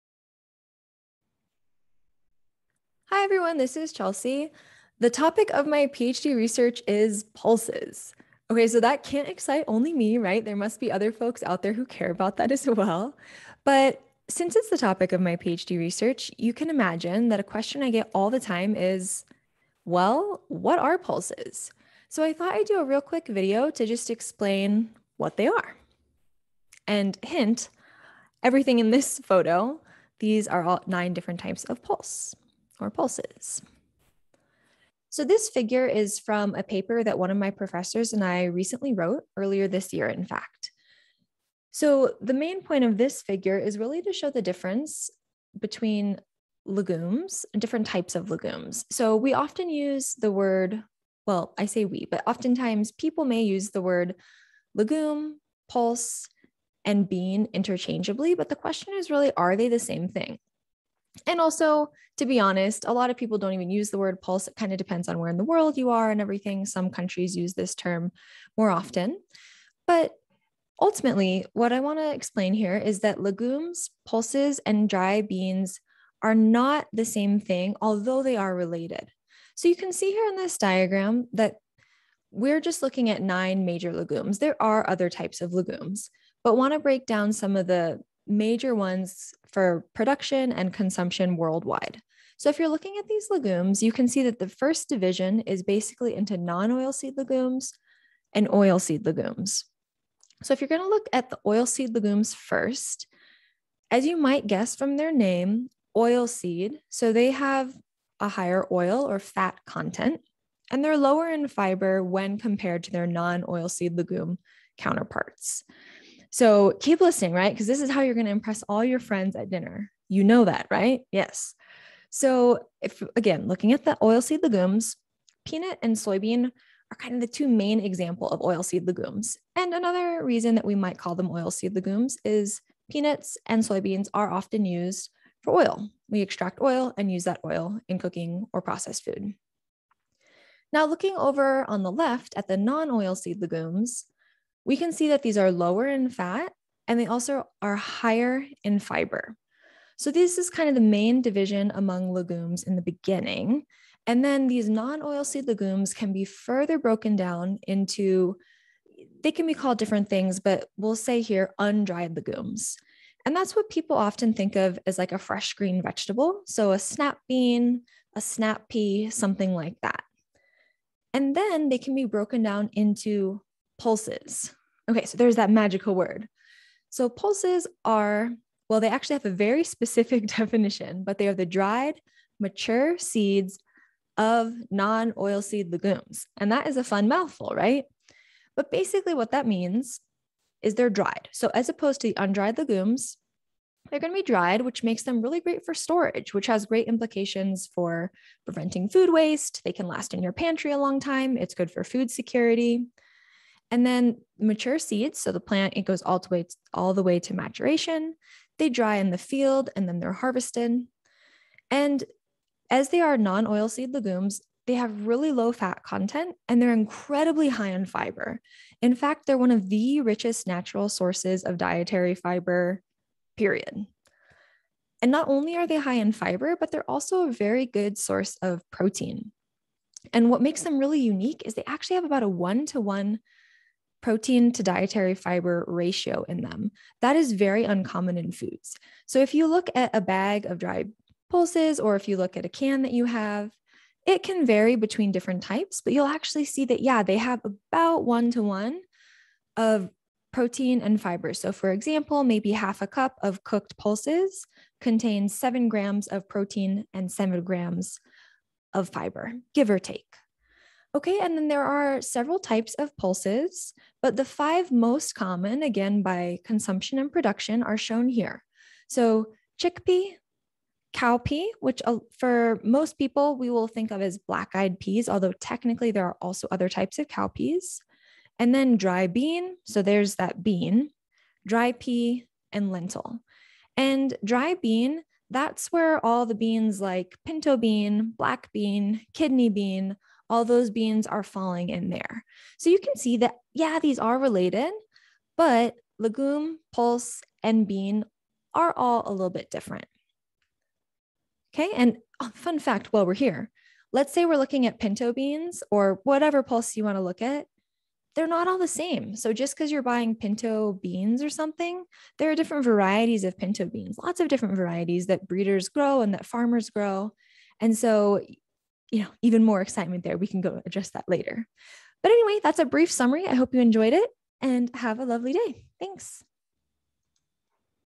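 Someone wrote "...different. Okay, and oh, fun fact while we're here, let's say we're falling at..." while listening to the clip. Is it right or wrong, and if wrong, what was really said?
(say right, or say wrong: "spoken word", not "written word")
wrong: "looking", not "falling".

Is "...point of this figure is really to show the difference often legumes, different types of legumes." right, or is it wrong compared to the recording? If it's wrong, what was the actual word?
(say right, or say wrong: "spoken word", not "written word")
wrong: "between", not "often".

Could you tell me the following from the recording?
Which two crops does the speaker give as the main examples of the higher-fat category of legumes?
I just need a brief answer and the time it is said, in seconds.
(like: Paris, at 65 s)
Peanut and soybean, at 125 s.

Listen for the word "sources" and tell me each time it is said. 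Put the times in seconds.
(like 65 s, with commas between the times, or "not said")
220 s, 227 s.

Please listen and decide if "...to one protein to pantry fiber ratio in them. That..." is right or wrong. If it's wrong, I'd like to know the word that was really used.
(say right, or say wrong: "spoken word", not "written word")
wrong: "dietary", not "pantry".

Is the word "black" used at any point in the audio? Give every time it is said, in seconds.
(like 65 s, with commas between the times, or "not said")
274 s, 288 s.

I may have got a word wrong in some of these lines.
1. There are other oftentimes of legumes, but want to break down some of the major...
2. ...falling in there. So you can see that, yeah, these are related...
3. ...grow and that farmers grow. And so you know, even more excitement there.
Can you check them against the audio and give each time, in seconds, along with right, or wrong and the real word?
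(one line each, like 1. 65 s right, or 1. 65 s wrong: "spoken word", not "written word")
1. 84 s wrong: "types", not "oftentimes"
2. 291 s right
3. 315 s right.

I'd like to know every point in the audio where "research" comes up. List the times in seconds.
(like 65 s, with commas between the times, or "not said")
6 s, 15 s.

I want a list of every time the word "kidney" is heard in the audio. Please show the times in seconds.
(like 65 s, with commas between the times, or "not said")
289 s.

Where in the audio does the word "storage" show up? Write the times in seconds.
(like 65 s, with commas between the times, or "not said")
195 s.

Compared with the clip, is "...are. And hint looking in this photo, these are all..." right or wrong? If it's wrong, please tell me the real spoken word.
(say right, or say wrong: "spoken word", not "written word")
wrong: "everything", not "looking".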